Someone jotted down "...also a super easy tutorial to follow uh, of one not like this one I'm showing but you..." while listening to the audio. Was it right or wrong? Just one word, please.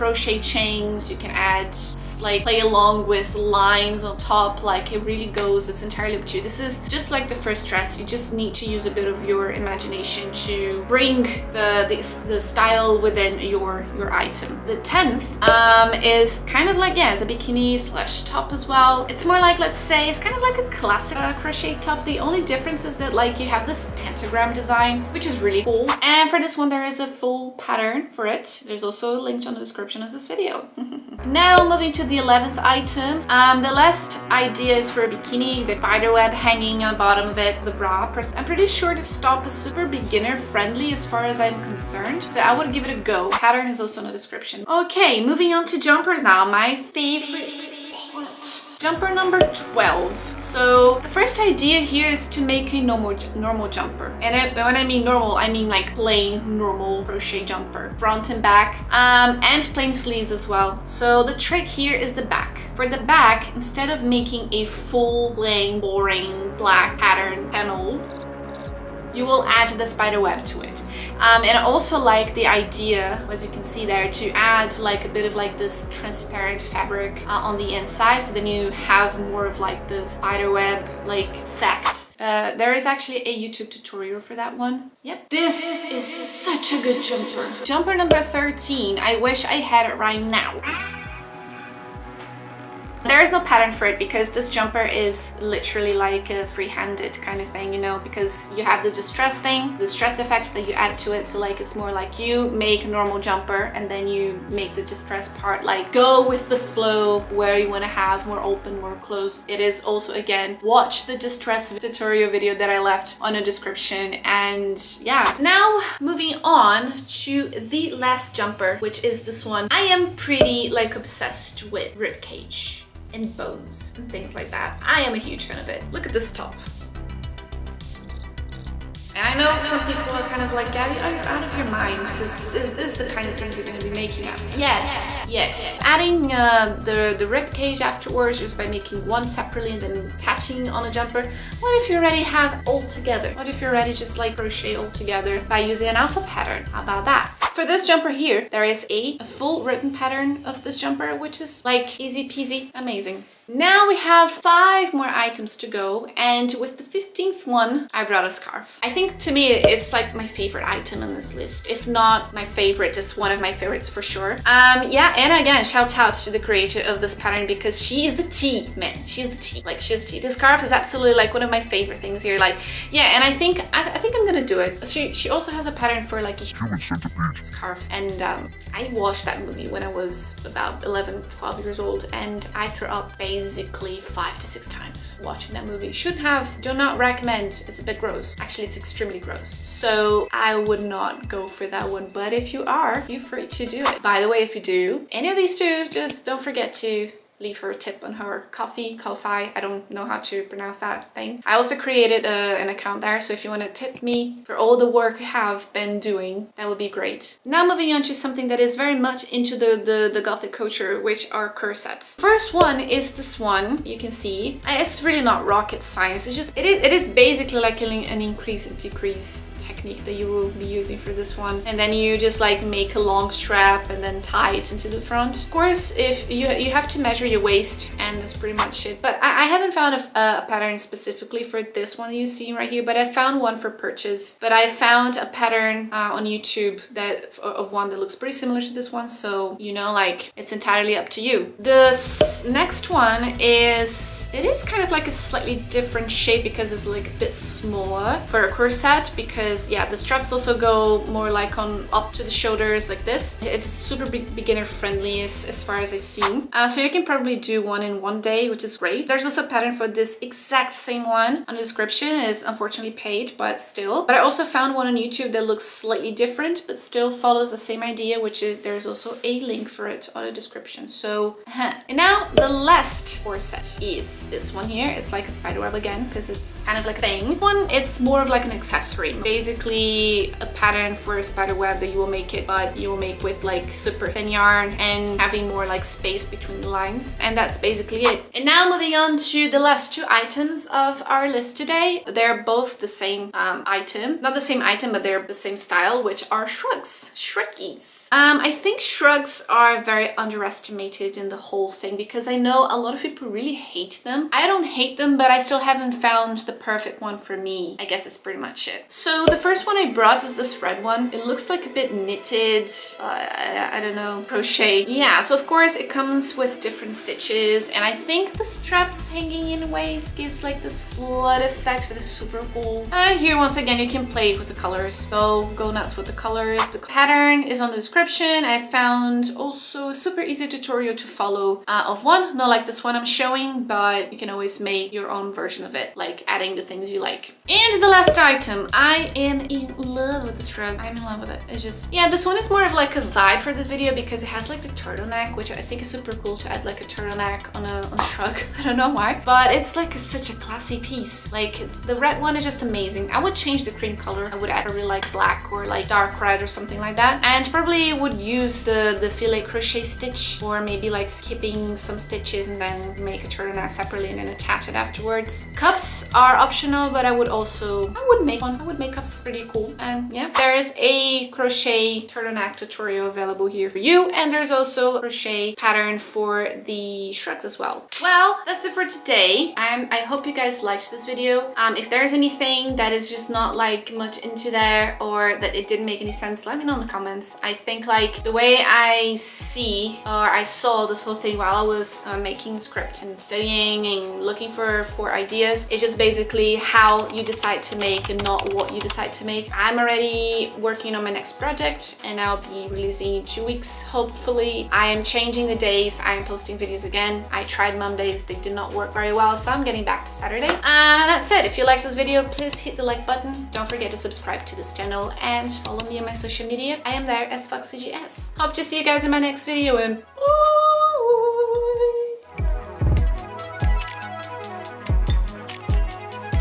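right.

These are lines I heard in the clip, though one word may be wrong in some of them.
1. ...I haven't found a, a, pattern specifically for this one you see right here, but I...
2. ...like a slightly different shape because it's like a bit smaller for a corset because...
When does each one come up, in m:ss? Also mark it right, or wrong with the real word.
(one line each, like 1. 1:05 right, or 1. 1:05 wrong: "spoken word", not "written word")
1. 3:49 right
2. 4:04 right.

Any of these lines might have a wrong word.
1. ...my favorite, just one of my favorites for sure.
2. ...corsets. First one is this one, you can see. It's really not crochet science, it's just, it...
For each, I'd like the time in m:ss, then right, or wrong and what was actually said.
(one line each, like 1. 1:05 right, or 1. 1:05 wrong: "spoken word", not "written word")
1. 2:42 right
2. 3:31 wrong: "rocket", not "crochet".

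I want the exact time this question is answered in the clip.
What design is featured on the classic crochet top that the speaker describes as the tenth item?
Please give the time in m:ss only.
0:23.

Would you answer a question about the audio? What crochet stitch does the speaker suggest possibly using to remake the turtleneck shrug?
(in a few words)
Filet crochet stitch.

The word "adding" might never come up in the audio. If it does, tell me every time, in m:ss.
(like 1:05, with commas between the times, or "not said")
2:15, 5:36.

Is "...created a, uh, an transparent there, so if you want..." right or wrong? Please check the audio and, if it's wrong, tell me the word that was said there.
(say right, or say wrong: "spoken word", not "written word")
wrong: "account", not "transparent".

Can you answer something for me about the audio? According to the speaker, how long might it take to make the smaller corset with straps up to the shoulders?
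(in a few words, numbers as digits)
One day.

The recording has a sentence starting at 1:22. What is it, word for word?
Uh, there is actually a YouTube tutorial for that one.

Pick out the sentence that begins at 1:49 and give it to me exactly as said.
It is also again, watch the distress tutorial video that I left on a description and yeah.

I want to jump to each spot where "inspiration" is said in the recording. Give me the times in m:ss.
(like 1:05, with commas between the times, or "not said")
not said.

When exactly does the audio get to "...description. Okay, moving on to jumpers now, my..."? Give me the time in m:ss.
0:44.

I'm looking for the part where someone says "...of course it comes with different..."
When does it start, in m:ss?
5:15.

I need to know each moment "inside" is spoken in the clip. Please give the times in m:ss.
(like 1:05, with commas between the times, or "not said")
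1:17.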